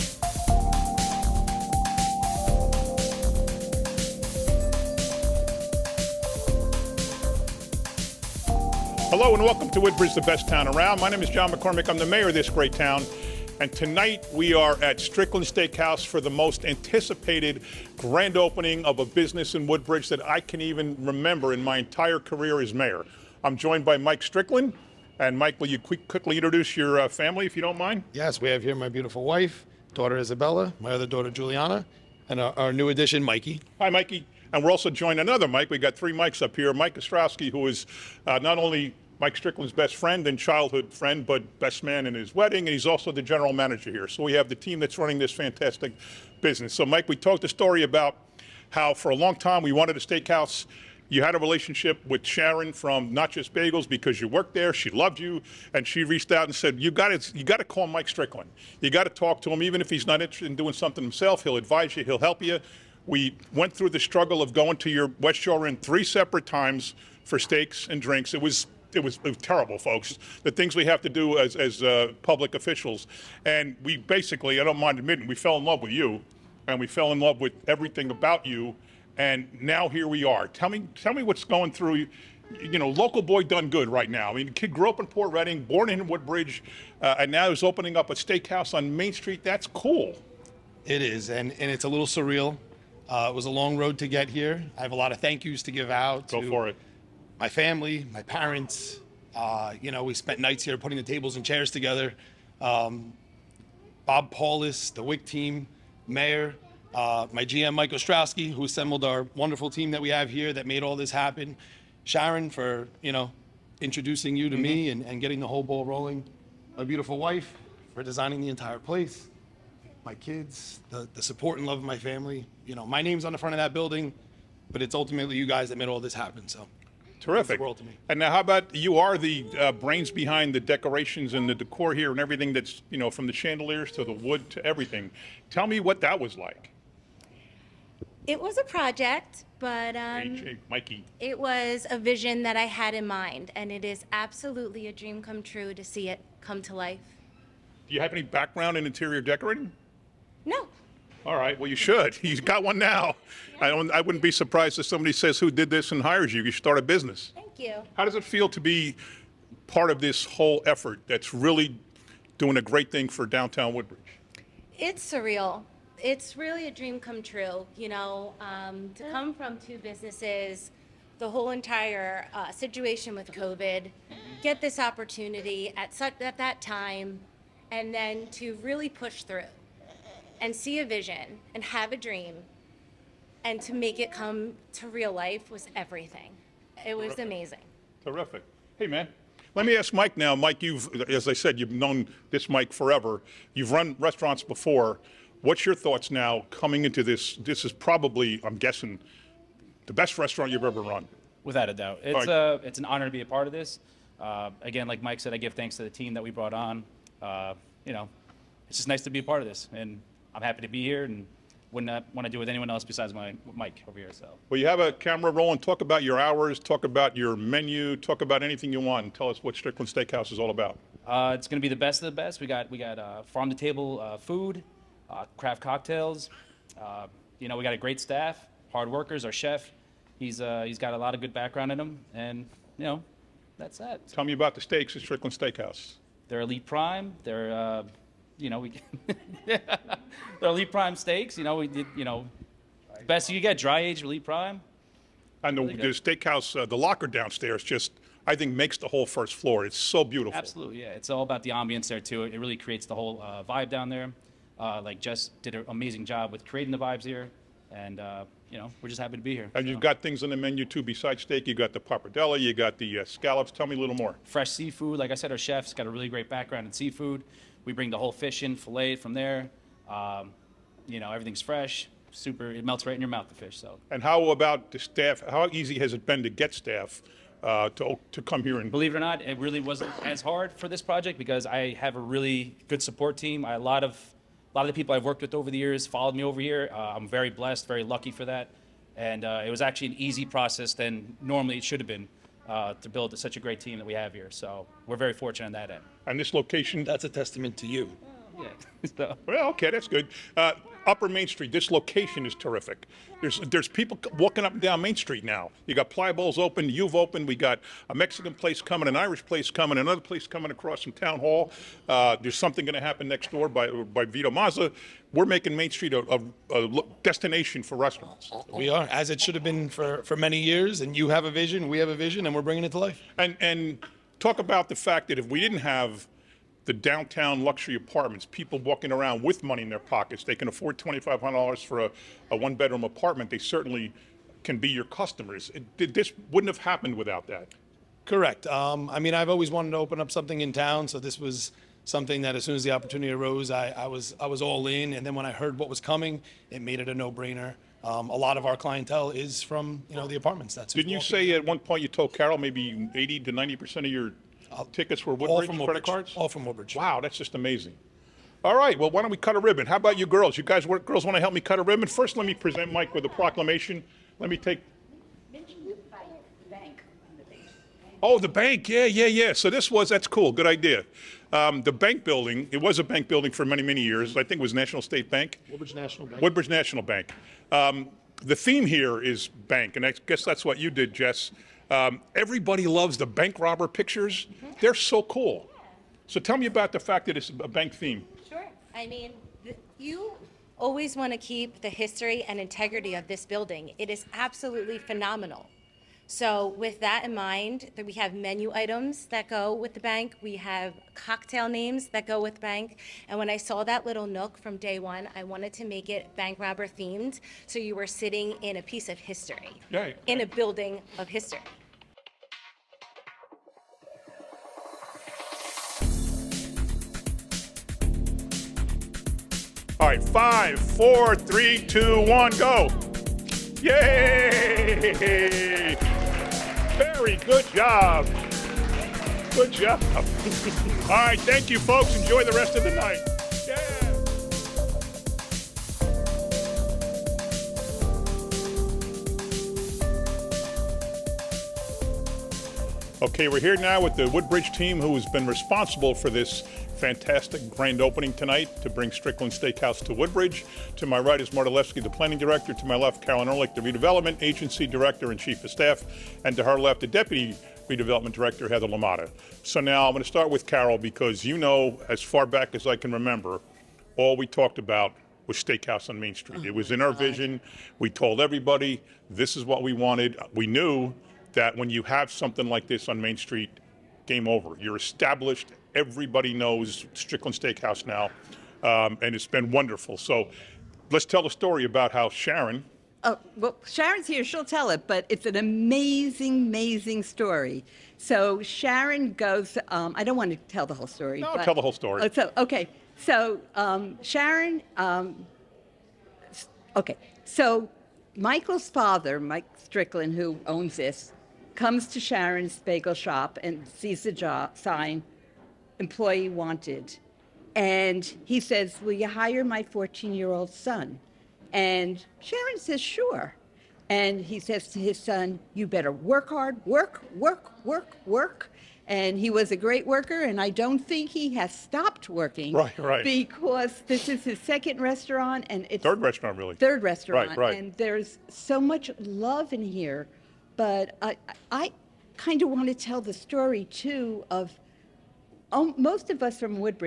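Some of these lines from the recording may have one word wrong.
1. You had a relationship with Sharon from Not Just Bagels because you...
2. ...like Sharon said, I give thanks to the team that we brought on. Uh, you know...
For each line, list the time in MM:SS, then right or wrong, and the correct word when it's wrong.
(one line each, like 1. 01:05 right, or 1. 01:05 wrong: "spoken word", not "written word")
1. 00:51 right
2. 03:24 wrong: "Mike", not "Sharon".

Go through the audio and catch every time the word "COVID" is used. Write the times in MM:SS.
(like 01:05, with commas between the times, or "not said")
02:53.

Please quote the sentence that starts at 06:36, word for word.
So, with that in mind, we have menu items that go with the bank.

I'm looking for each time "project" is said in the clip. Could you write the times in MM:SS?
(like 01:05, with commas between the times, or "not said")
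02:18, 04:40.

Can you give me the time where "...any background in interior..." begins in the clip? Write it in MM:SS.
02:28.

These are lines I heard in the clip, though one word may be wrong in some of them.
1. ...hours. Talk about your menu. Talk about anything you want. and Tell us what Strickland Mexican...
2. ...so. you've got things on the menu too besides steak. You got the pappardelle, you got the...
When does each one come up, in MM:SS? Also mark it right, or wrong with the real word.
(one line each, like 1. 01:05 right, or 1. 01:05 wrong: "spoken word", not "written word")
1. 03:36 wrong: "Steakhouse", not "Mexican"
2. 04:19 right.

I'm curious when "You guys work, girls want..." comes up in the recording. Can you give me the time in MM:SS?
06:00.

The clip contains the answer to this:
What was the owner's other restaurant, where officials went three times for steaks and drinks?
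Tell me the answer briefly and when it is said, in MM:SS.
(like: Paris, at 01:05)
West Shore Inn, at 01:05.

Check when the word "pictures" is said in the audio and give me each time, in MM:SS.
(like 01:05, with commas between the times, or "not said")
06:23.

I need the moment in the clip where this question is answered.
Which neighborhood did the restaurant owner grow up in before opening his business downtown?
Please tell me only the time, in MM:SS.
01:25.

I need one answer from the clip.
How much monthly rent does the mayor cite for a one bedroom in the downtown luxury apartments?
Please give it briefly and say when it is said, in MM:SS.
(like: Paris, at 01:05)
$2,500, at 05:30.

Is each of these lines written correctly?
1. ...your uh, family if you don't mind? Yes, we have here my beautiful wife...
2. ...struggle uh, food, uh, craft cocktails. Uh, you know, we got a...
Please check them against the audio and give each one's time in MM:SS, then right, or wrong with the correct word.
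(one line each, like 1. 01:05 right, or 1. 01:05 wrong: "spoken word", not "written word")
1. 00:26 right
2. 03:43 wrong: "table", not "struggle".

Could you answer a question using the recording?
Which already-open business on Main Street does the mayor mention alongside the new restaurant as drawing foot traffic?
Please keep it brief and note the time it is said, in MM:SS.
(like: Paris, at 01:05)
Playa Bowls, at 05:05.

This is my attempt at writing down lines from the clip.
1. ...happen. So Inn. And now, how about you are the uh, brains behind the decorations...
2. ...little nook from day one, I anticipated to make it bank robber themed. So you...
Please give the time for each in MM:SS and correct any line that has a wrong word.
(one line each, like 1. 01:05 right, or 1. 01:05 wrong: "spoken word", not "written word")
1. 02:06 wrong: "Terrific", not "Inn"
2. 06:43 wrong: "wanted", not "anticipated".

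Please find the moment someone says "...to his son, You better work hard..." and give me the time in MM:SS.
08:34.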